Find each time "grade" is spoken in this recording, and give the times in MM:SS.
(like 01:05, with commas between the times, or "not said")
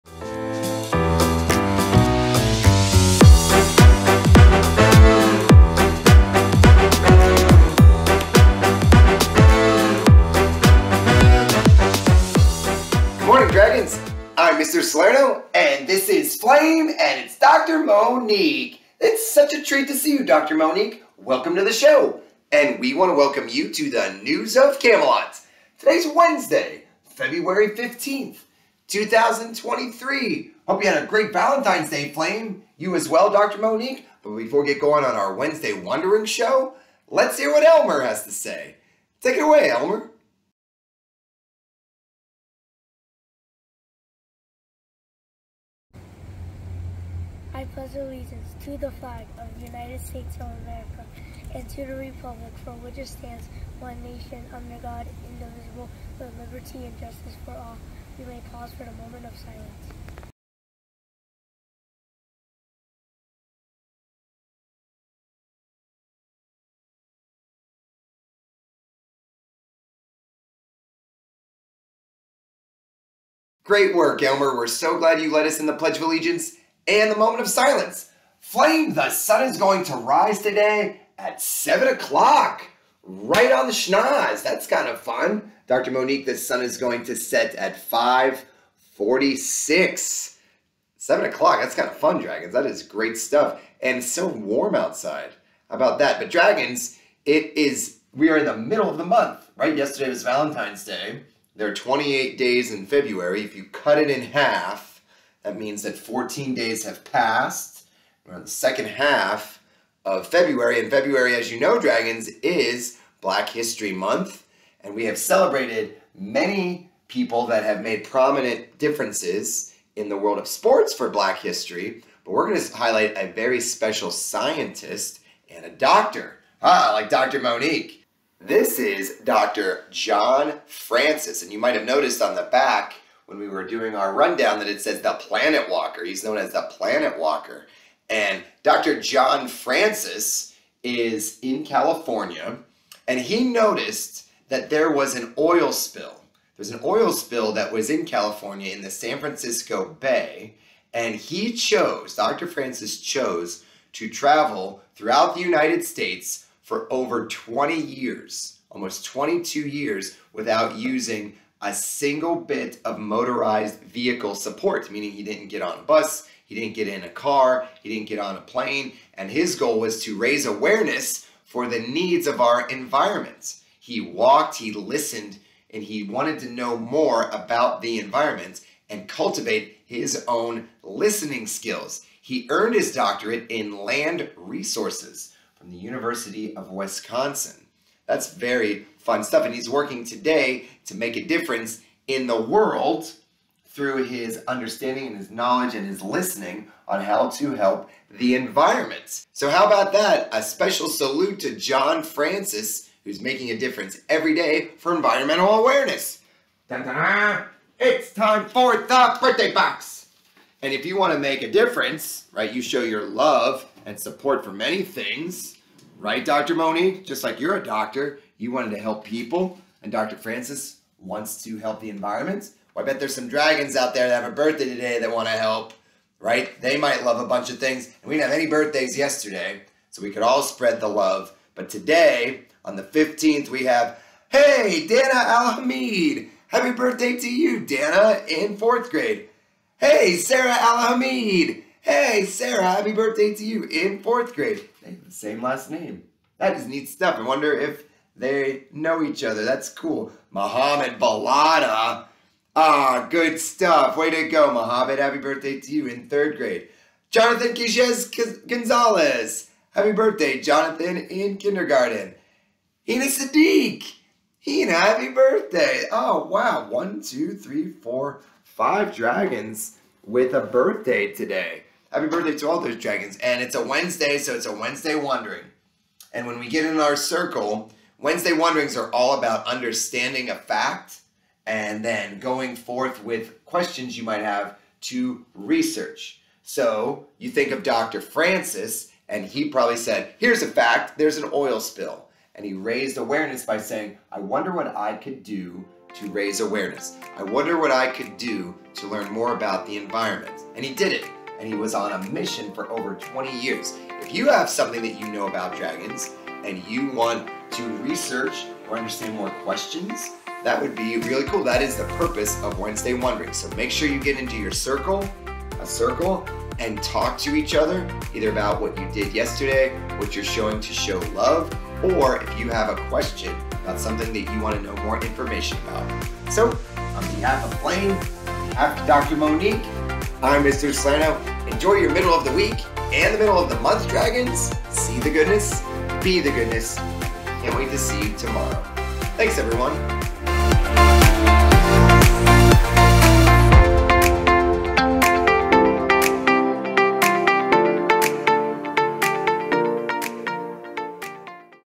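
03:58, 04:04, 04:16.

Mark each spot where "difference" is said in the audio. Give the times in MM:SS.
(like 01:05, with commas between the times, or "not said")
01:58, 03:11, 03:23, 03:31.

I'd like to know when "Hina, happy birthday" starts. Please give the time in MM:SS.
04:24.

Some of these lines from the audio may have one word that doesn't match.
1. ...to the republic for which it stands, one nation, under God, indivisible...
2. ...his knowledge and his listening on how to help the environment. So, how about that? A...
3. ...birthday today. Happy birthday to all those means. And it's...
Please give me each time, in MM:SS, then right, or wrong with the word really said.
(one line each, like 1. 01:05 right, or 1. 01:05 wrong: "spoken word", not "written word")
1. 00:51 right
2. 03:15 right
3. 04:30 wrong: "dragons", not "means".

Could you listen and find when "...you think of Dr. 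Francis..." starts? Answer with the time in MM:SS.
04:47.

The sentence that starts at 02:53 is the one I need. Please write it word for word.
He walked, he listened, and he wanted to know more about the environment and cultivate his own listening skills.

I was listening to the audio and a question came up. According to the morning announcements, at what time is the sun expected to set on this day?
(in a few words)
5:46.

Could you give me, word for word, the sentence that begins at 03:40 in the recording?
Francis wants to help the environment.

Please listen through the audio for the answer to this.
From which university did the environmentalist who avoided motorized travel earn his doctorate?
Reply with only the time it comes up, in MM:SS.
03:05.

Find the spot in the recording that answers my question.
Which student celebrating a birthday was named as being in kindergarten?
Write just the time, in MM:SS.
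04:17.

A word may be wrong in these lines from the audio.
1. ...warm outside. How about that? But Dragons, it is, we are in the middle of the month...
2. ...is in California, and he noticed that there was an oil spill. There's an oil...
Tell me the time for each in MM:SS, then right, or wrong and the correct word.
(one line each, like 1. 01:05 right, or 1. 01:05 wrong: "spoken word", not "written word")
1. 01:34 right
2. 02:20 right.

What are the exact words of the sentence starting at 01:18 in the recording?
Flame, the sun is going to rise today at 7 o'clock, right on the schnoz.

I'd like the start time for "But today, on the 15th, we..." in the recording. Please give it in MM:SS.
03:51.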